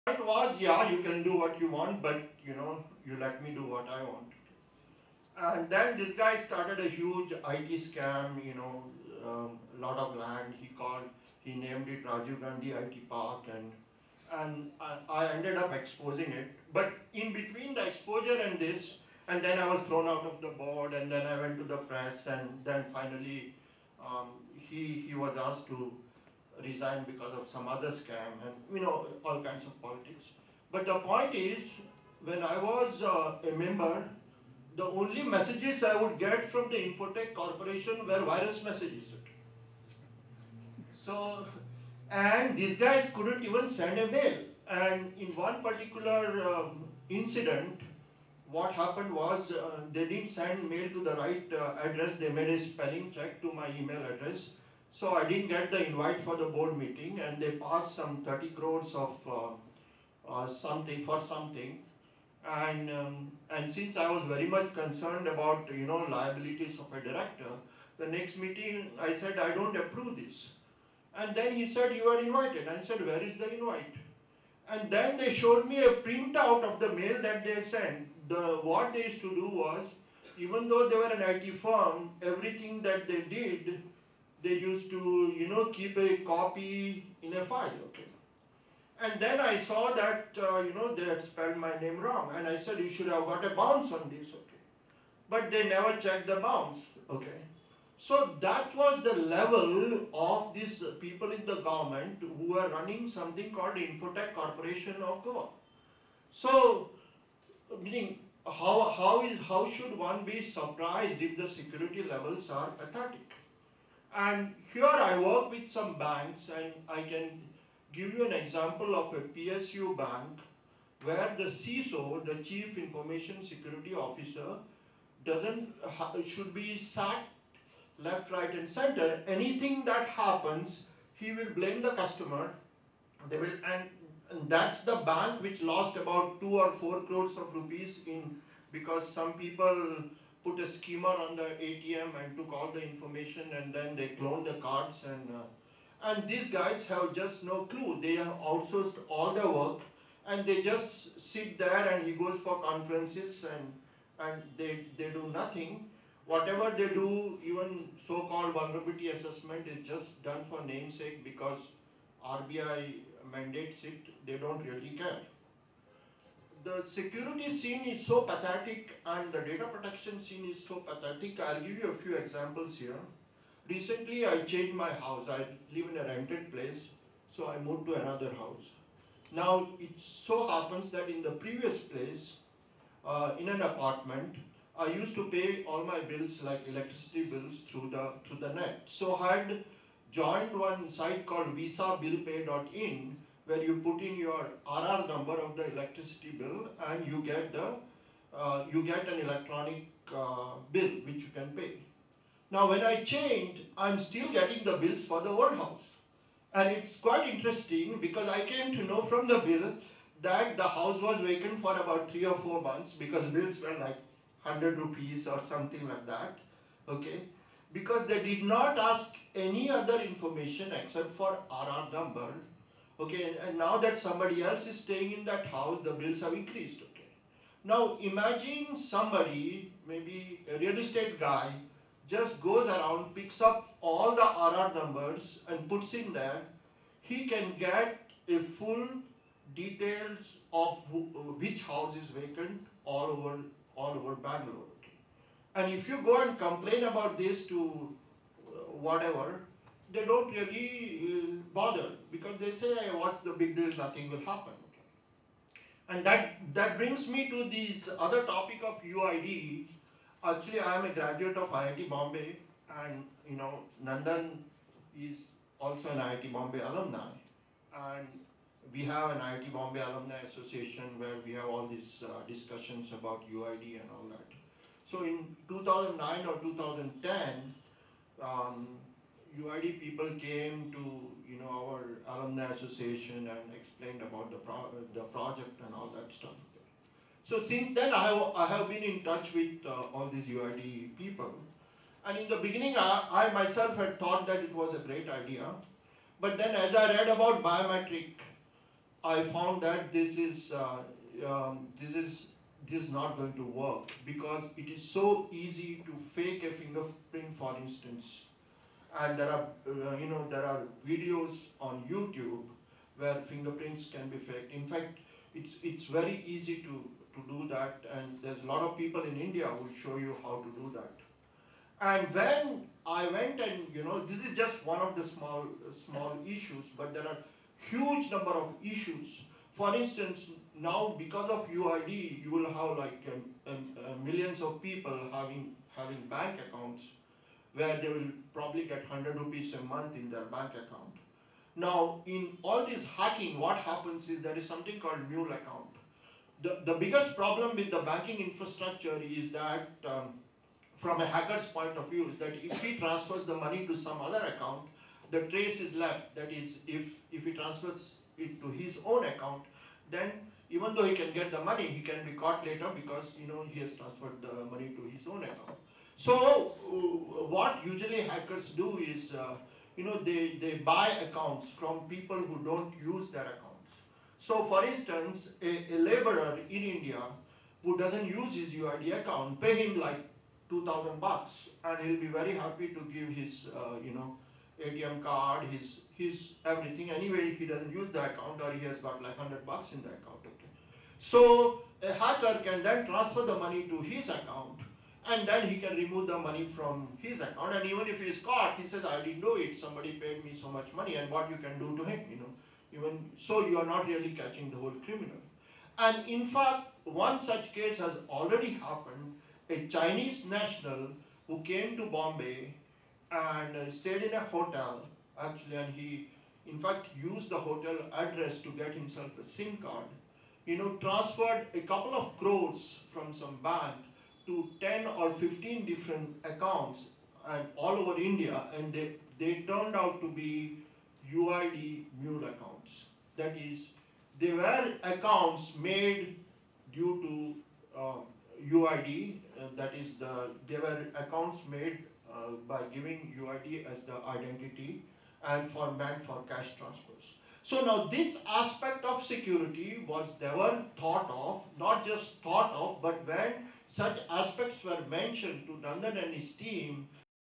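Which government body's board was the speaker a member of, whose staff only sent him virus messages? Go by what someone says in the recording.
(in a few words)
Infotech Corporation of Goa.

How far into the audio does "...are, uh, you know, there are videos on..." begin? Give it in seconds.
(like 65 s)
309 s.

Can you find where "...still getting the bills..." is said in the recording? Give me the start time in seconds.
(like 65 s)
203 s.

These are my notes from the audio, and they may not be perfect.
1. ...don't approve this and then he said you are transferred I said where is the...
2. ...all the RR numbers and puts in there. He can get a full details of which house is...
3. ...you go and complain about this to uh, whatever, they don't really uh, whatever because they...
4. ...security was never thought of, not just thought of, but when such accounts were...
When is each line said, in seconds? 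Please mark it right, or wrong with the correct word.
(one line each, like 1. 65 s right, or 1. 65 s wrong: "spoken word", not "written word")
1. 69 s wrong: "invited", not "transferred"
2. 233 s right
3. 245 s wrong: "bother", not "whatever"
4. 449 s wrong: "aspects", not "accounts".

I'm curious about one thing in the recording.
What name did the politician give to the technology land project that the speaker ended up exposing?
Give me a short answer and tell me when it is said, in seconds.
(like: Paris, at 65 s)
Rajiv Gandhi IT Park, at 12 s.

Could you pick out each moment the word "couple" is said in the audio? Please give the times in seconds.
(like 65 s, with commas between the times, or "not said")
421 s.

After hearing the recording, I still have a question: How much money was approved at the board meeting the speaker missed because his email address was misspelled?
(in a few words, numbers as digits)
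30 crores.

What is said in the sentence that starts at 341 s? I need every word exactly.
Now, in all this hacking, what happens is there is something called mule account.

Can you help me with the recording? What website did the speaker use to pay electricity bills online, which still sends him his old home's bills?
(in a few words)
visabillpay.in.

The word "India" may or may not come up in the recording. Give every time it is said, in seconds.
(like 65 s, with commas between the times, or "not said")
319 s, 376 s, 427 s.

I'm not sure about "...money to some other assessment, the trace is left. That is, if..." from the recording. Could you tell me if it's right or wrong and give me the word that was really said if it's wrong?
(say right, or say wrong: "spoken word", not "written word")
wrong: "account", not "assessment".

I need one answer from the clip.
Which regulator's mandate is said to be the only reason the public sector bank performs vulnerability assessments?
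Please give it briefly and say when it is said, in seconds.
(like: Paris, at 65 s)
RBI, at 162 s.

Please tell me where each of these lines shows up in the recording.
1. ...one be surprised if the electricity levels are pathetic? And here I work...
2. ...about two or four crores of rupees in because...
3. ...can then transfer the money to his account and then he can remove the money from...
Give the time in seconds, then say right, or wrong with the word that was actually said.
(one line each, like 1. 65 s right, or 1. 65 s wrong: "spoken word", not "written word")
1. 109 s wrong: "security", not "electricity"
2. 135 s right
3. 392 s right.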